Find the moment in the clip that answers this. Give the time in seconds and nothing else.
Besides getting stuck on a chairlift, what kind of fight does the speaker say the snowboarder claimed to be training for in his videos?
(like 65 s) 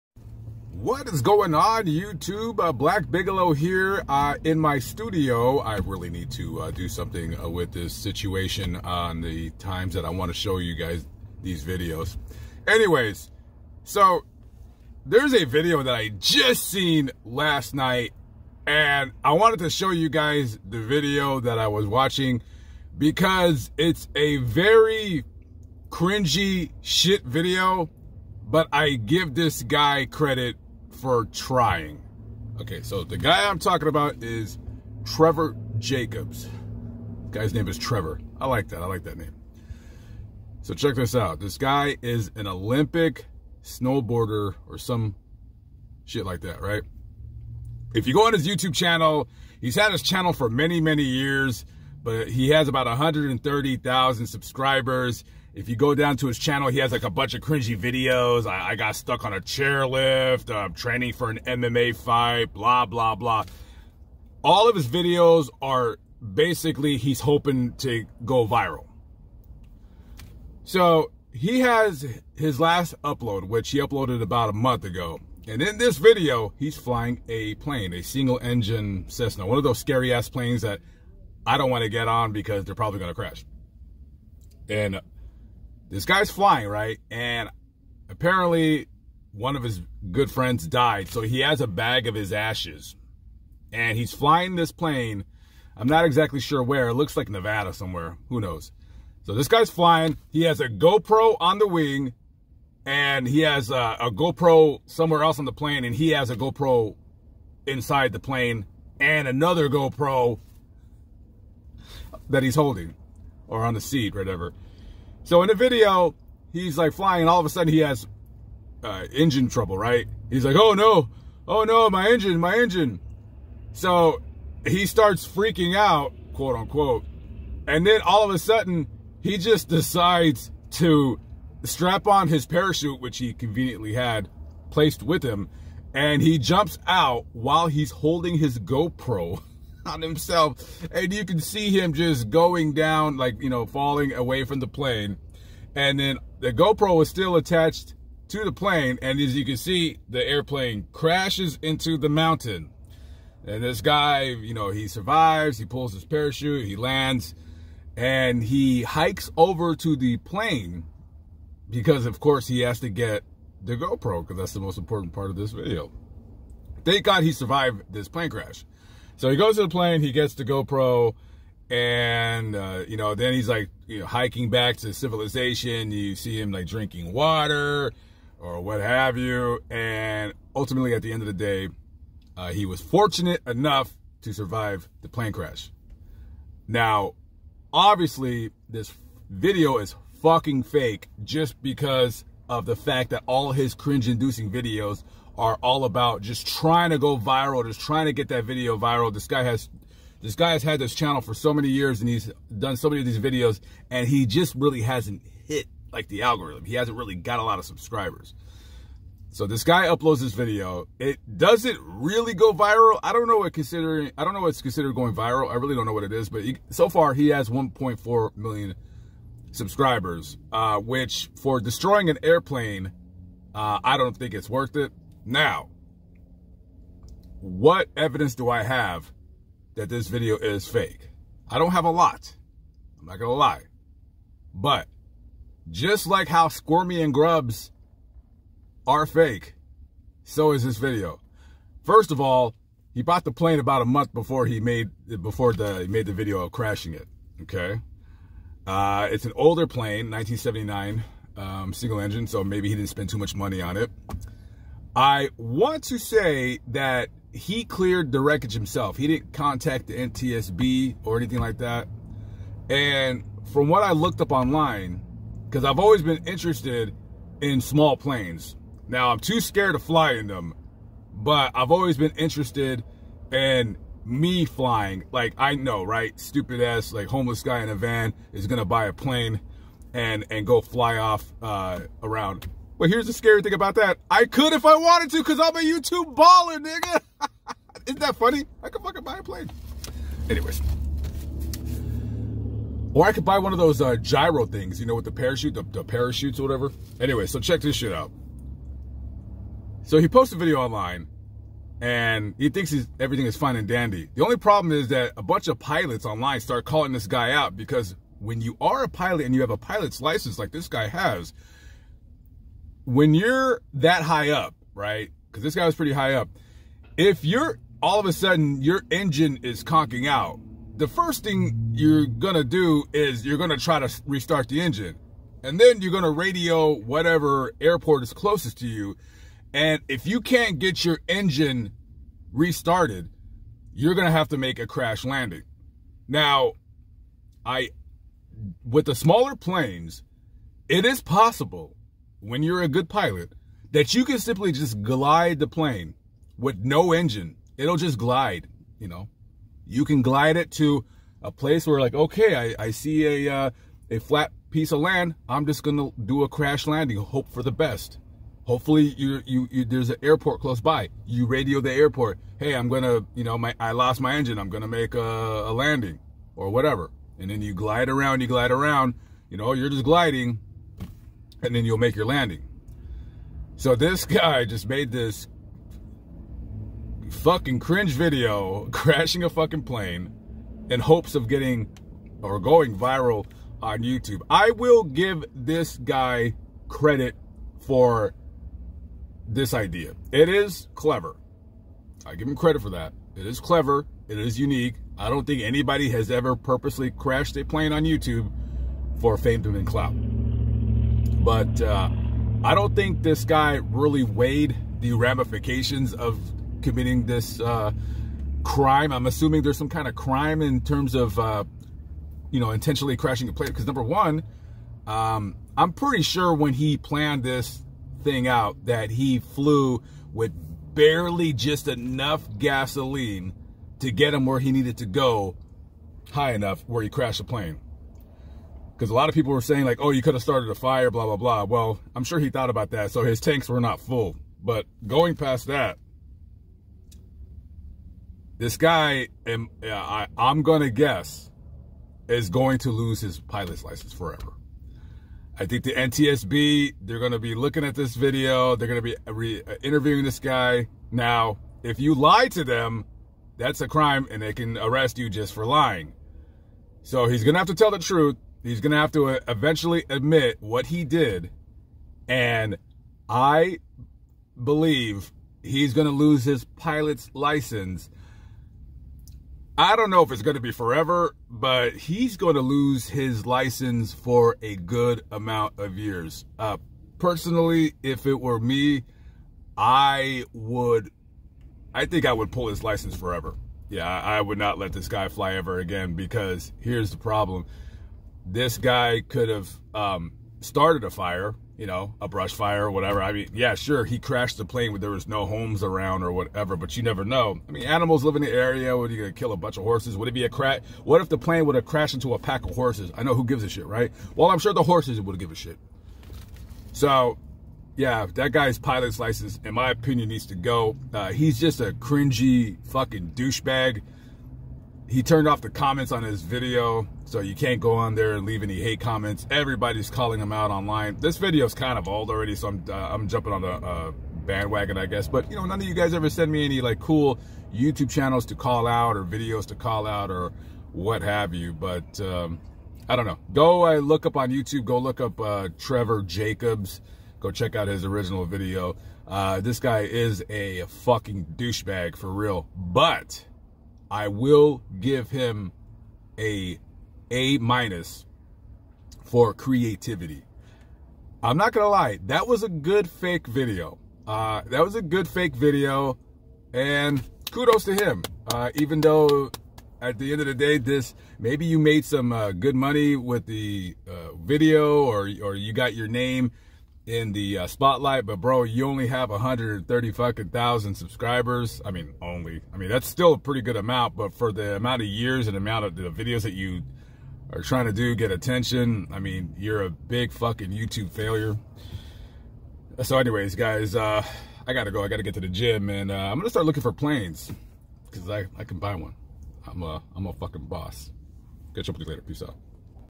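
61 s.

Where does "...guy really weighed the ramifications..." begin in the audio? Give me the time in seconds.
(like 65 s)
403 s.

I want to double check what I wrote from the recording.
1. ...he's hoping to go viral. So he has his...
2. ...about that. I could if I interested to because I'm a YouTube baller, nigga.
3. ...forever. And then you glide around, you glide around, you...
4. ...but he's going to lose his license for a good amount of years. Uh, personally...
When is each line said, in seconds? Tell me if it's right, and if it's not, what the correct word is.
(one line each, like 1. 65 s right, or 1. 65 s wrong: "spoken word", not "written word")
1. 66 s right
2. 283 s wrong: "wanted", not "interested"
3. 366 s wrong: "whatever", not "forever"
4. 471 s right.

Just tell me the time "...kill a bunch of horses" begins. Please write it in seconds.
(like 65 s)
499 s.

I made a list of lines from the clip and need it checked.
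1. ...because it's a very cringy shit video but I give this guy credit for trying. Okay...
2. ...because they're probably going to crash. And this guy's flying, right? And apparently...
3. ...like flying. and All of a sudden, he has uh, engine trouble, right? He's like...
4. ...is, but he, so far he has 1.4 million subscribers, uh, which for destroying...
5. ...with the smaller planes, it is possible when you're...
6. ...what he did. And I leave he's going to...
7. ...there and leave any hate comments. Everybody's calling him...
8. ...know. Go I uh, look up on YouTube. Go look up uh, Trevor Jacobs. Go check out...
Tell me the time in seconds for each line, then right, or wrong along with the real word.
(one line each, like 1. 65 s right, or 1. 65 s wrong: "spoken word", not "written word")
1. 22 s right
2. 82 s right
3. 116 s right
4. 216 s right
5. 338 s right
6. 460 s wrong: "believe", not "leave"
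7. 517 s right
8. 533 s right.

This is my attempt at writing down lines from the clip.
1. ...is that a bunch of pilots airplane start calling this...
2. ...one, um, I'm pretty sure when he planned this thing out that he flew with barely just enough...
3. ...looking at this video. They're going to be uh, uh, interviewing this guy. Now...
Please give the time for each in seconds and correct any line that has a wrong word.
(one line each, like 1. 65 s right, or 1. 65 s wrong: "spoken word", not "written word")
1. 304 s wrong: "online", not "airplane"
2. 413 s right
3. 447 s right.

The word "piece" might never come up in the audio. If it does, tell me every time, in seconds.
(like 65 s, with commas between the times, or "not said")
354 s.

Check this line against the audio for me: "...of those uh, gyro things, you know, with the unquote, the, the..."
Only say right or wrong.
wrong.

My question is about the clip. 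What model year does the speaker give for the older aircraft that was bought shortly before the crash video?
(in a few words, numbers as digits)
1979.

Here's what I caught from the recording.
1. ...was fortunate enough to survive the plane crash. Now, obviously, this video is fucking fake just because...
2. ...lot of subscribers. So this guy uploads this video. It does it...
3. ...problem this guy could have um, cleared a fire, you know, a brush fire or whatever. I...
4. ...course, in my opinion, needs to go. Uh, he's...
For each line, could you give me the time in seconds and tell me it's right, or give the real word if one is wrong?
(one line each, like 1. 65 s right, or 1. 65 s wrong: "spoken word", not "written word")
1. 182 s right
2. 207 s right
3. 486 s wrong: "started", not "cleared"
4. 508 s wrong: "license", not "course".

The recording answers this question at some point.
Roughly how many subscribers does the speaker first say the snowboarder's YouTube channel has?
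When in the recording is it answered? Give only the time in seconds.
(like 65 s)
52 s.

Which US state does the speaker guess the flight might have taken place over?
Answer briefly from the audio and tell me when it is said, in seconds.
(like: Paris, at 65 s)
Nevada, at 97 s.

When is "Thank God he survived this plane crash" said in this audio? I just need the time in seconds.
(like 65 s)
166 s.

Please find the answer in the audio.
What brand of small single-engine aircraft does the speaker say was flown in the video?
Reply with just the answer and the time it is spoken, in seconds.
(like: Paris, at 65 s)
Cessna, at 79 s.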